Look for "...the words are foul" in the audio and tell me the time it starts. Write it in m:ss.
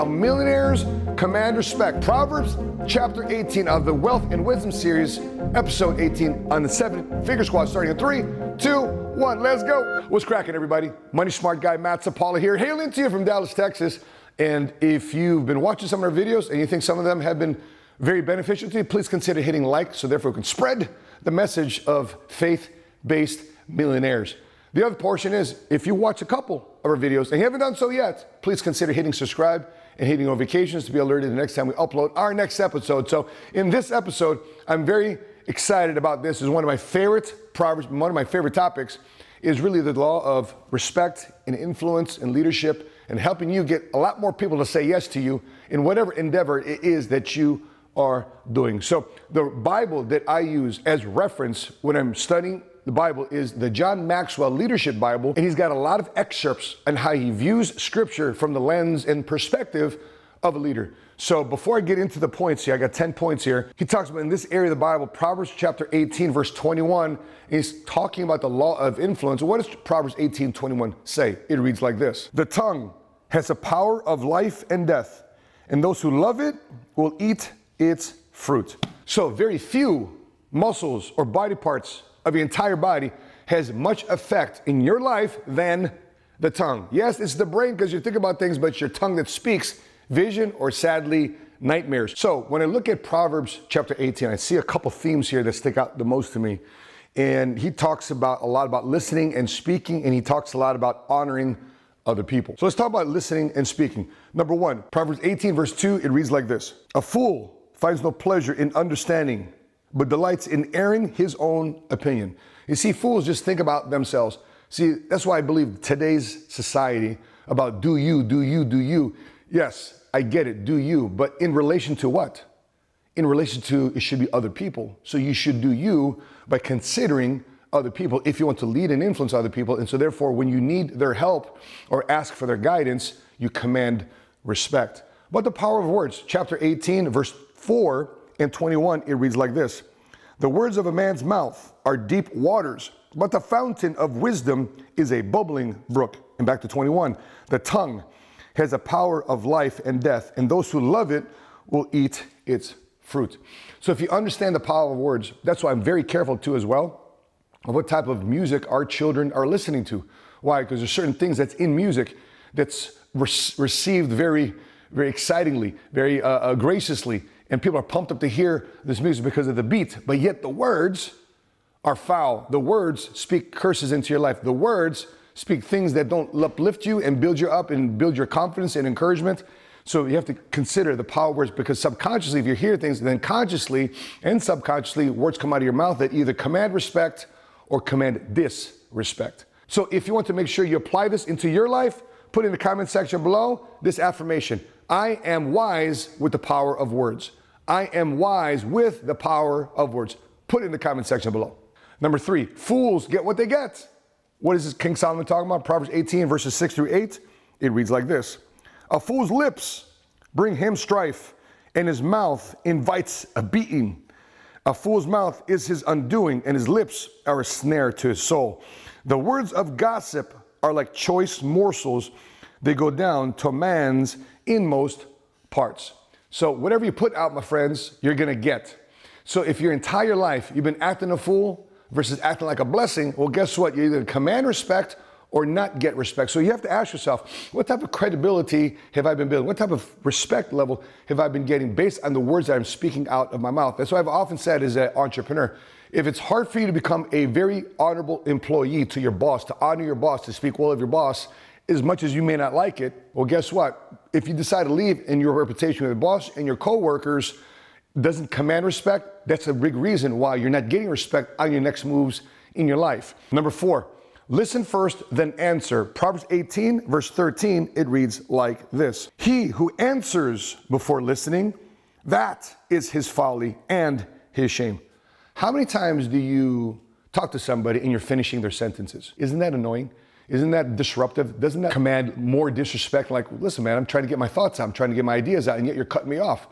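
2:50.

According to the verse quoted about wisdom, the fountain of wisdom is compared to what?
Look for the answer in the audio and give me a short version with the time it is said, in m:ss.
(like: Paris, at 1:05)
a bubbling brook, at 2:25.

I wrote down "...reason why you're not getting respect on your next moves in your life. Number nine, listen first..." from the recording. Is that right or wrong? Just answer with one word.
wrong.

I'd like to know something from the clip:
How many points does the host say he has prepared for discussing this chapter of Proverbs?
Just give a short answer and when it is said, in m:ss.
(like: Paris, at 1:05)
10, at 1:02.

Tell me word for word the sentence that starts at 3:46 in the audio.
So, whatever you put out, my friends, you're gonna get.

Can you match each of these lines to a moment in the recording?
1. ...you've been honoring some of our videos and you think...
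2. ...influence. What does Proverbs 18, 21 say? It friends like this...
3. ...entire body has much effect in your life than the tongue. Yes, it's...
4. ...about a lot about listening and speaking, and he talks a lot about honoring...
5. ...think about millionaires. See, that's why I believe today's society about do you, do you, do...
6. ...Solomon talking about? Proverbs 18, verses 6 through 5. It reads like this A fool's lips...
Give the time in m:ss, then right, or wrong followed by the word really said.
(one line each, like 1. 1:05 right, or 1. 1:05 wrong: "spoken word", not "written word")
1. 0:15 wrong: "watching", not "honoring"
2. 1:08 wrong: "reads", not "friends"
3. 1:22 right
4. 1:38 right
5. 1:53 wrong: "themselves", not "millionaires"
6. 3:24 wrong: "8", not "5".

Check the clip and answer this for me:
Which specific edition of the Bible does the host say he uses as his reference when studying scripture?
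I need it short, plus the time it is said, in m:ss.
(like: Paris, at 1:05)
John Maxwell Leadership Bible, at 0:53.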